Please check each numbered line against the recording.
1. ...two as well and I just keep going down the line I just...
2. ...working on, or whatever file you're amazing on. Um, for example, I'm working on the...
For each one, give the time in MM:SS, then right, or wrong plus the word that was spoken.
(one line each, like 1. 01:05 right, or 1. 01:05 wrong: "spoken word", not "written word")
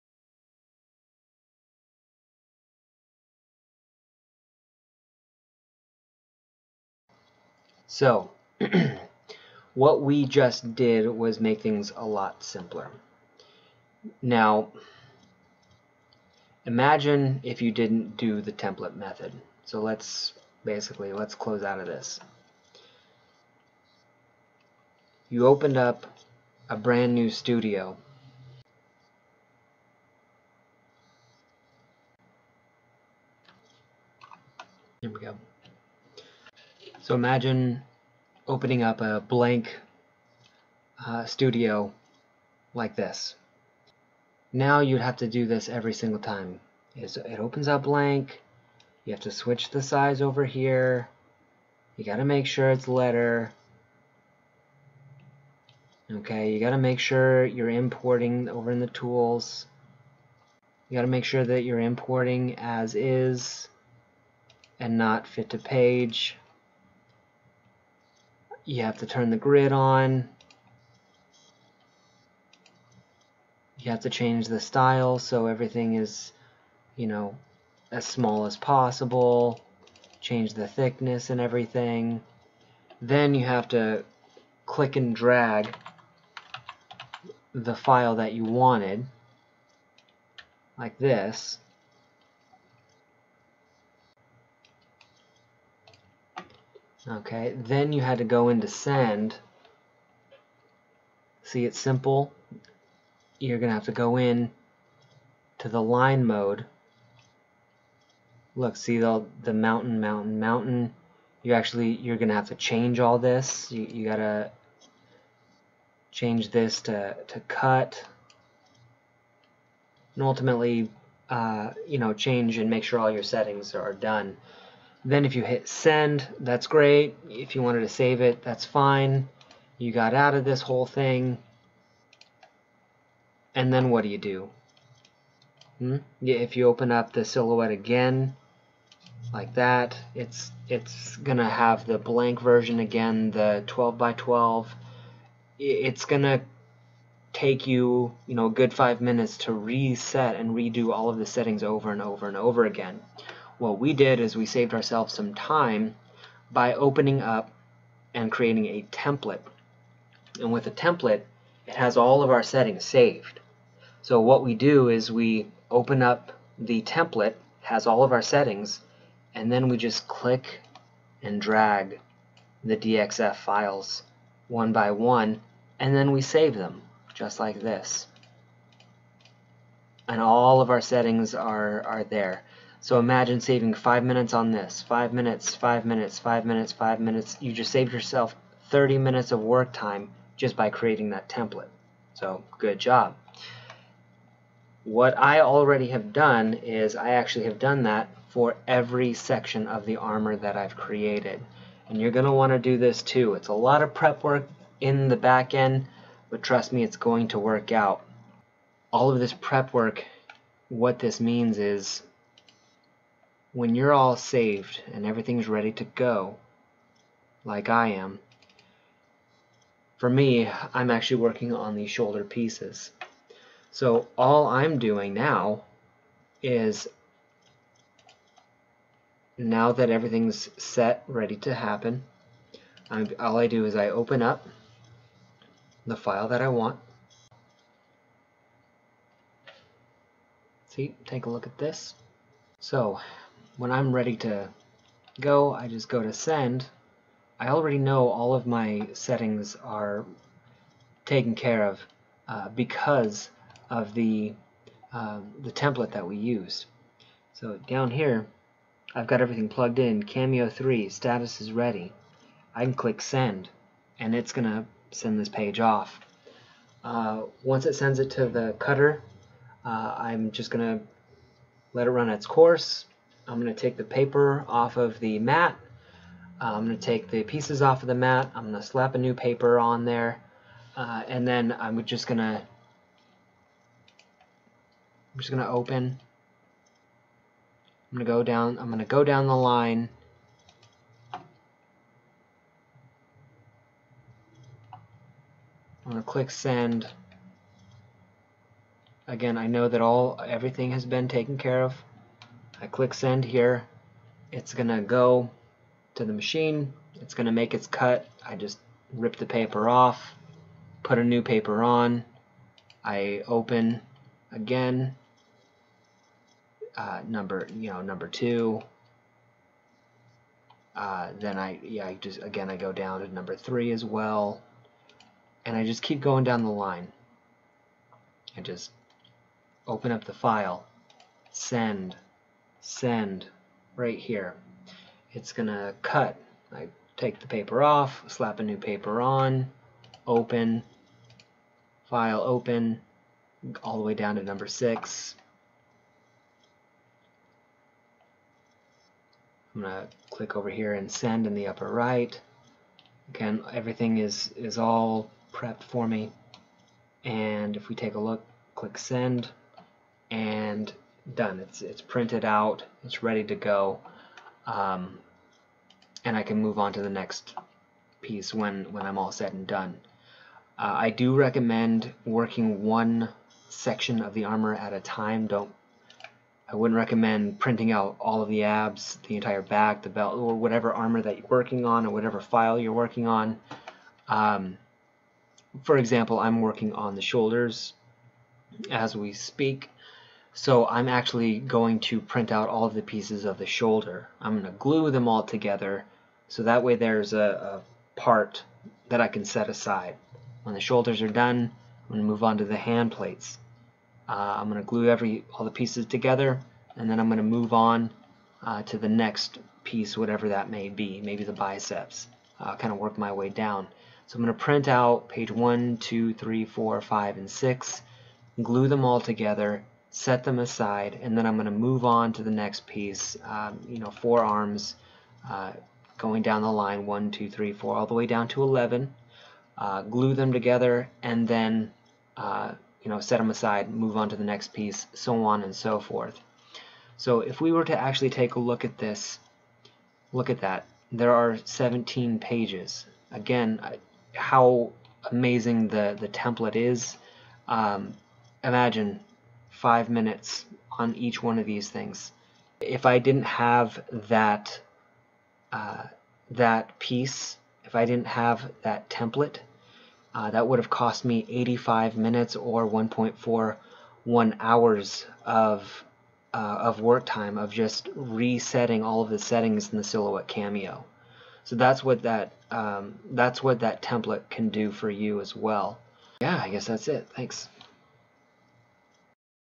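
1. 05:23 wrong: "three", not "two"
2. 06:21 wrong: "working", not "amazing".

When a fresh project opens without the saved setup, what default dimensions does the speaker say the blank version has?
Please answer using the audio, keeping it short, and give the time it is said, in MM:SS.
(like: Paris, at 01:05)
12 by 12, at 02:23.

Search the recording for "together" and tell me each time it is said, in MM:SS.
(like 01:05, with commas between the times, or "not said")
06:35, 06:45, 06:58, 07:10.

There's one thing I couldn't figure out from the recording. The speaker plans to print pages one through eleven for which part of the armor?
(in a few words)
forearms.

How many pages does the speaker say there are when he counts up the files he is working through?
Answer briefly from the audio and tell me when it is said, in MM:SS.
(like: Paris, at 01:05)
17, at 07:21.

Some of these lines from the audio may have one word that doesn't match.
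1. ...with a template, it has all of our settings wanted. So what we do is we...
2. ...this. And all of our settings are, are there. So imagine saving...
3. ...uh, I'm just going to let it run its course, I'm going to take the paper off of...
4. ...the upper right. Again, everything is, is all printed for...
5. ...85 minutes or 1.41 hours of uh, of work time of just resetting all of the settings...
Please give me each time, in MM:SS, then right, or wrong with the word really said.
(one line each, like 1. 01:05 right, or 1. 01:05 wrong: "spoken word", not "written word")
1. 02:40 wrong: "saved", not "wanted"
2. 02:57 right
3. 04:29 right
4. 05:51 wrong: "prepped", not "printed"
5. 07:41 right.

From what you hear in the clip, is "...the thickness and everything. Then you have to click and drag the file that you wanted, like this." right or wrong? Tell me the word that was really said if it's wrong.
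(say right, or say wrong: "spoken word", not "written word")
right.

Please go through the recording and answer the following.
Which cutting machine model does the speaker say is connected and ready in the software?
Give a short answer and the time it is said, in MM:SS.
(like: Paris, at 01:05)
Cameo 3, at 04:20.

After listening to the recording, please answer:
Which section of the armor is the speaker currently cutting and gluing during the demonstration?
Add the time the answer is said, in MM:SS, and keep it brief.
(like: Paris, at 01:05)
shoulder pieces, at 03:41.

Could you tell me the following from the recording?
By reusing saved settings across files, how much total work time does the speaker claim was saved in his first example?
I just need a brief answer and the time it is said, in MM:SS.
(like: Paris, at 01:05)
30 minutes, at 03:08.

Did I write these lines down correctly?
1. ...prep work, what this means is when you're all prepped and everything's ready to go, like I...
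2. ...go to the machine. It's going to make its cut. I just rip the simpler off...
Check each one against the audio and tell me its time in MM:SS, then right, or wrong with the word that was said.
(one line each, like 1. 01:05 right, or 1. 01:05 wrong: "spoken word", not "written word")
1. 03:29 wrong: "saved", not "prepped"
2. 05:04 wrong: "paper", not "simpler".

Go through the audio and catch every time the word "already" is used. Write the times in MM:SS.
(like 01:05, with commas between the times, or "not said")
03:15, 04:07.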